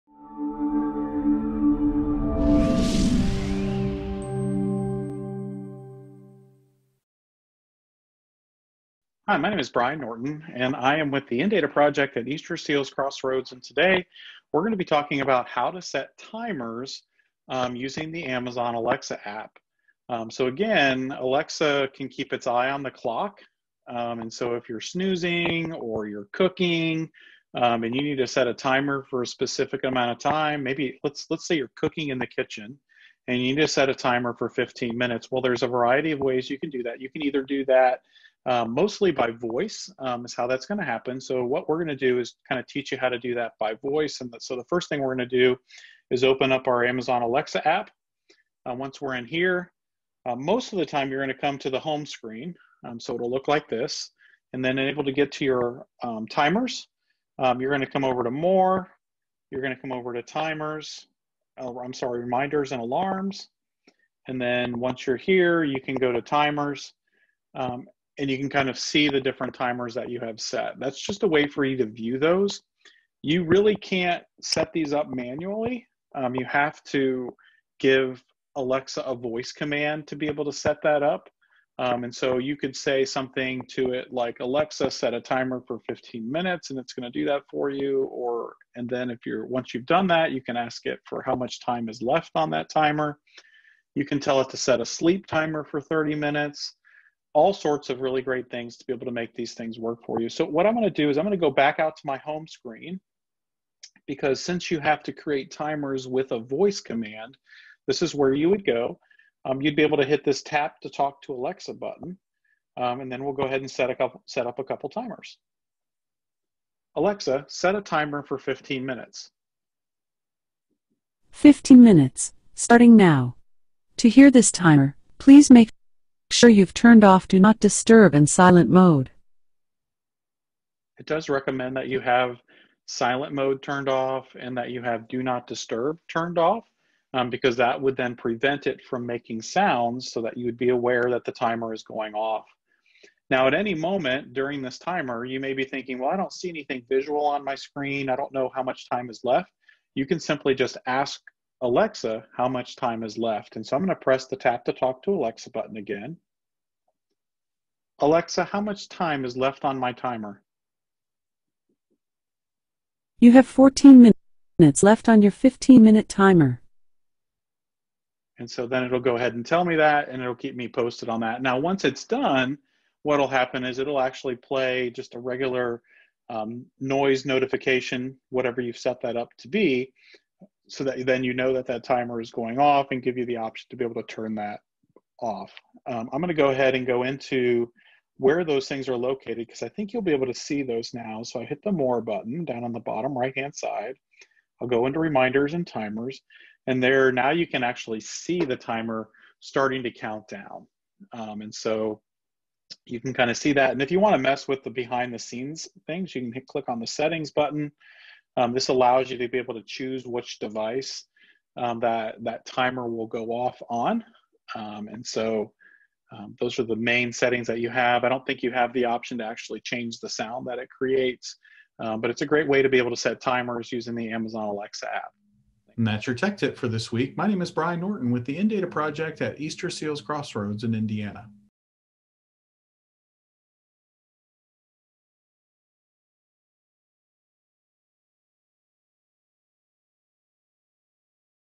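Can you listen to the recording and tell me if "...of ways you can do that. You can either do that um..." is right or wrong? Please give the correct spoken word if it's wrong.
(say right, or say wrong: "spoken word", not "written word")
right.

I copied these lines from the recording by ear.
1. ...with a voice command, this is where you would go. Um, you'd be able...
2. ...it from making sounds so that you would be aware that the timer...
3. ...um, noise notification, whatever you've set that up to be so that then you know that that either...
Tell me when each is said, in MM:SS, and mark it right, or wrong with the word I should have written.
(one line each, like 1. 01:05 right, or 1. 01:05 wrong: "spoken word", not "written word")
1. 01:46 right
2. 02:18 right
3. 02:56 wrong: "timer", not "either".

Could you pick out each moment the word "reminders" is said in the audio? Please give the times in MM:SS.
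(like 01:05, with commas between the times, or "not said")
01:02, 03:14.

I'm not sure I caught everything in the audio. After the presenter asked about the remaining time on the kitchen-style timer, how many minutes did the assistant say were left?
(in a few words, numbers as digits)
14 minutes.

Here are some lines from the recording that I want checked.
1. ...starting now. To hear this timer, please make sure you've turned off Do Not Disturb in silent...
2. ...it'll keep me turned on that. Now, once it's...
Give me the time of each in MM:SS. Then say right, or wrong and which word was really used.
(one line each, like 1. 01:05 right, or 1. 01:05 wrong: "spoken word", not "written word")
1. 02:02 right
2. 02:50 wrong: "posted", not "turned".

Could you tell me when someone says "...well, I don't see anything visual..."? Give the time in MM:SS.
02:25.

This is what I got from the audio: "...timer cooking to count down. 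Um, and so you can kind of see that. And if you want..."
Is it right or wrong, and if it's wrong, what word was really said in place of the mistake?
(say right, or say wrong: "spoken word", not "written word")
wrong: "starting", not "cooking".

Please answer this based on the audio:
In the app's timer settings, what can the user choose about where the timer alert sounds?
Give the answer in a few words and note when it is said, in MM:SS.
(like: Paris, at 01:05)
Which device, at 03:30.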